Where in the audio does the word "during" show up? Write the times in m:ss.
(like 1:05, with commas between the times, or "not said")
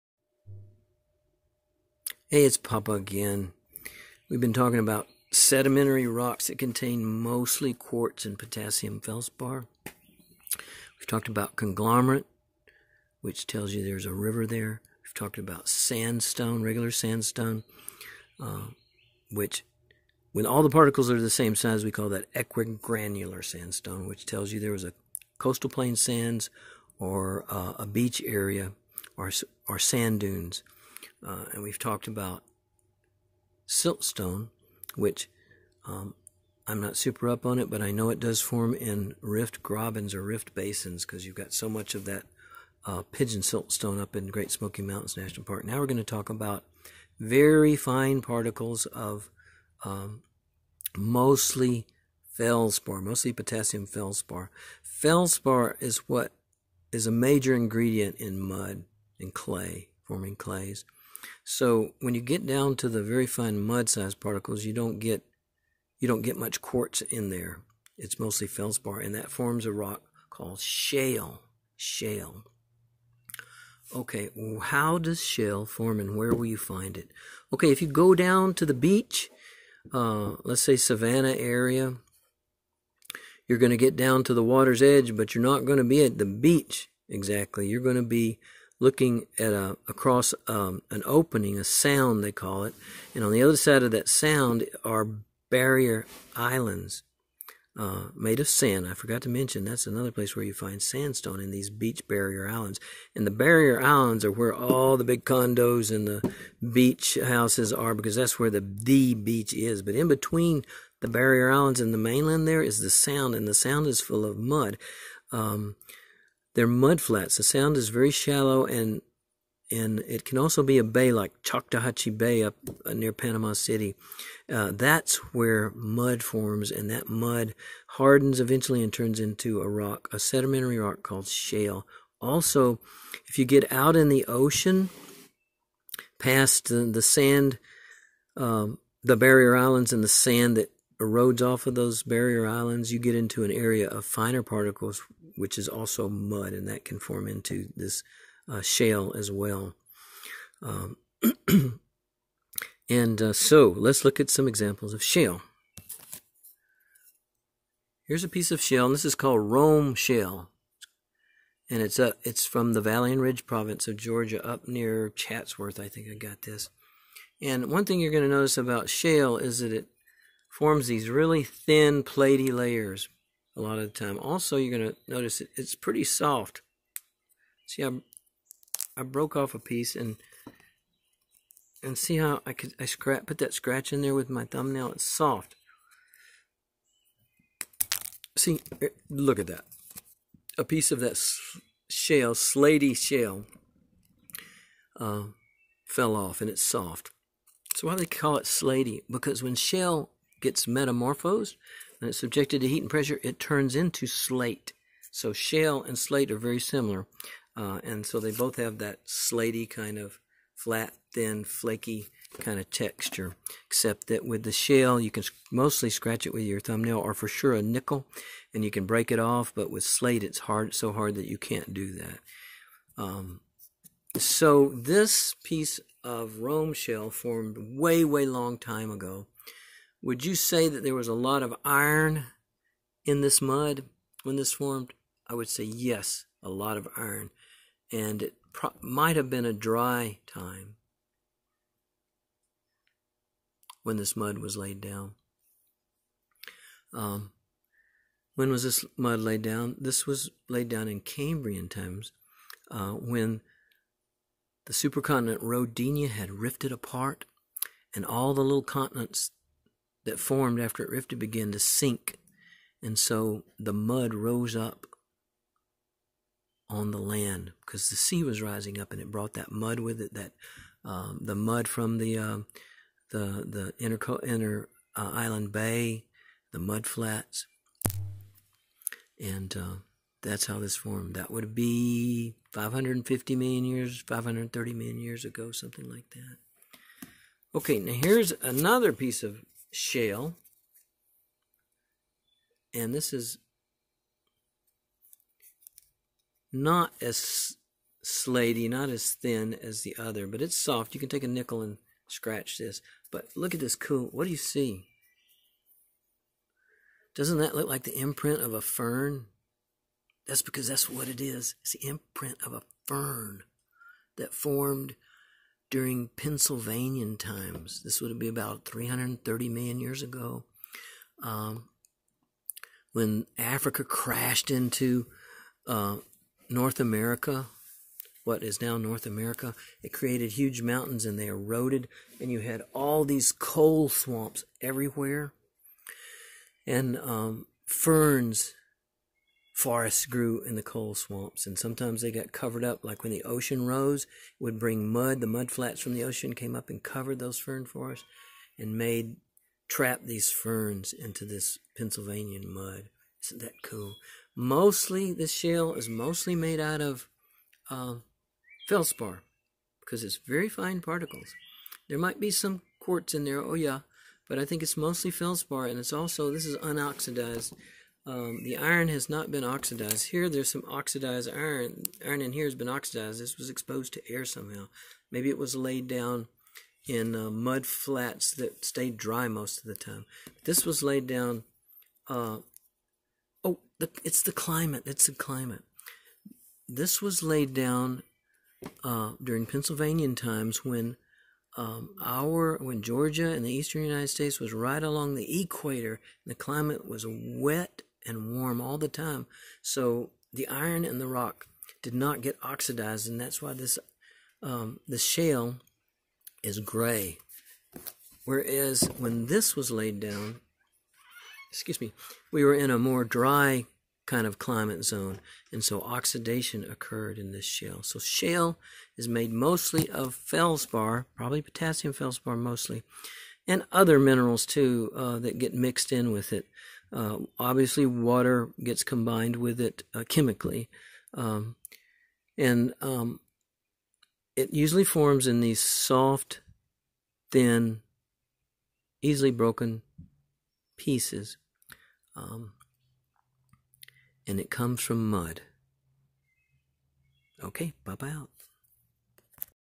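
5:15, 6:29.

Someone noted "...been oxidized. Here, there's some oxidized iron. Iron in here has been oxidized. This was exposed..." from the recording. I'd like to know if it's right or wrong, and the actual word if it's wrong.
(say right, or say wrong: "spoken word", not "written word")
right.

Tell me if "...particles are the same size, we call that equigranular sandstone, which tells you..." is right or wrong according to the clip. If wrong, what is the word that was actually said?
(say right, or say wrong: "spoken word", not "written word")
right.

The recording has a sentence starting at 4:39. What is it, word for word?
And uh, that's how this formed.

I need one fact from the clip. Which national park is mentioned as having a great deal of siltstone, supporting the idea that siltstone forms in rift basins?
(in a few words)
Great Smoky Mountains National Park.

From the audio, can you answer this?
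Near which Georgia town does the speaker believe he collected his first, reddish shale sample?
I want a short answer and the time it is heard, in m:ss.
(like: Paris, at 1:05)
Chatsworth, at 2:45.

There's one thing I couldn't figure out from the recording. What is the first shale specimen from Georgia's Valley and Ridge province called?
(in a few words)
Rome shale.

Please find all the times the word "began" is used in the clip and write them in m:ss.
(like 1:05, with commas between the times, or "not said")
4:21.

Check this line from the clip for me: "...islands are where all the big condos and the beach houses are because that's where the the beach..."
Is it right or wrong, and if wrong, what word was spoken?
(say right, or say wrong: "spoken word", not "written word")
right.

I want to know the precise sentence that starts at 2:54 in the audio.
Also, you're going to notice it, it's pretty soft.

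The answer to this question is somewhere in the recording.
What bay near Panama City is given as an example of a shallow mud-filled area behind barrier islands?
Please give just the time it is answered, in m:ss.
2:01.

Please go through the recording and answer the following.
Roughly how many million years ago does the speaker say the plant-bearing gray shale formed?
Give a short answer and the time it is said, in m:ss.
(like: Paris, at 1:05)
330 million years, at 5:18.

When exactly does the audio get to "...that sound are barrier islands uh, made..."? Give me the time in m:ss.
1:33.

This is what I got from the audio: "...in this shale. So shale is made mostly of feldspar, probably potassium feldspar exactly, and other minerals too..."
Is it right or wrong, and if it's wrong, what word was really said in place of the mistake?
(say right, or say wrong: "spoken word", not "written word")
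wrong: "mostly", not "exactly".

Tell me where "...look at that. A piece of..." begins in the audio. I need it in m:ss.
3:09.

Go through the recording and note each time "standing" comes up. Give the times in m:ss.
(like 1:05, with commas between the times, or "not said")
not said.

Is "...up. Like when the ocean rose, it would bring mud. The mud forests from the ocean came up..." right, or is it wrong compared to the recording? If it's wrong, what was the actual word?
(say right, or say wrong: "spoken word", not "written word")
wrong: "flats", not "forests".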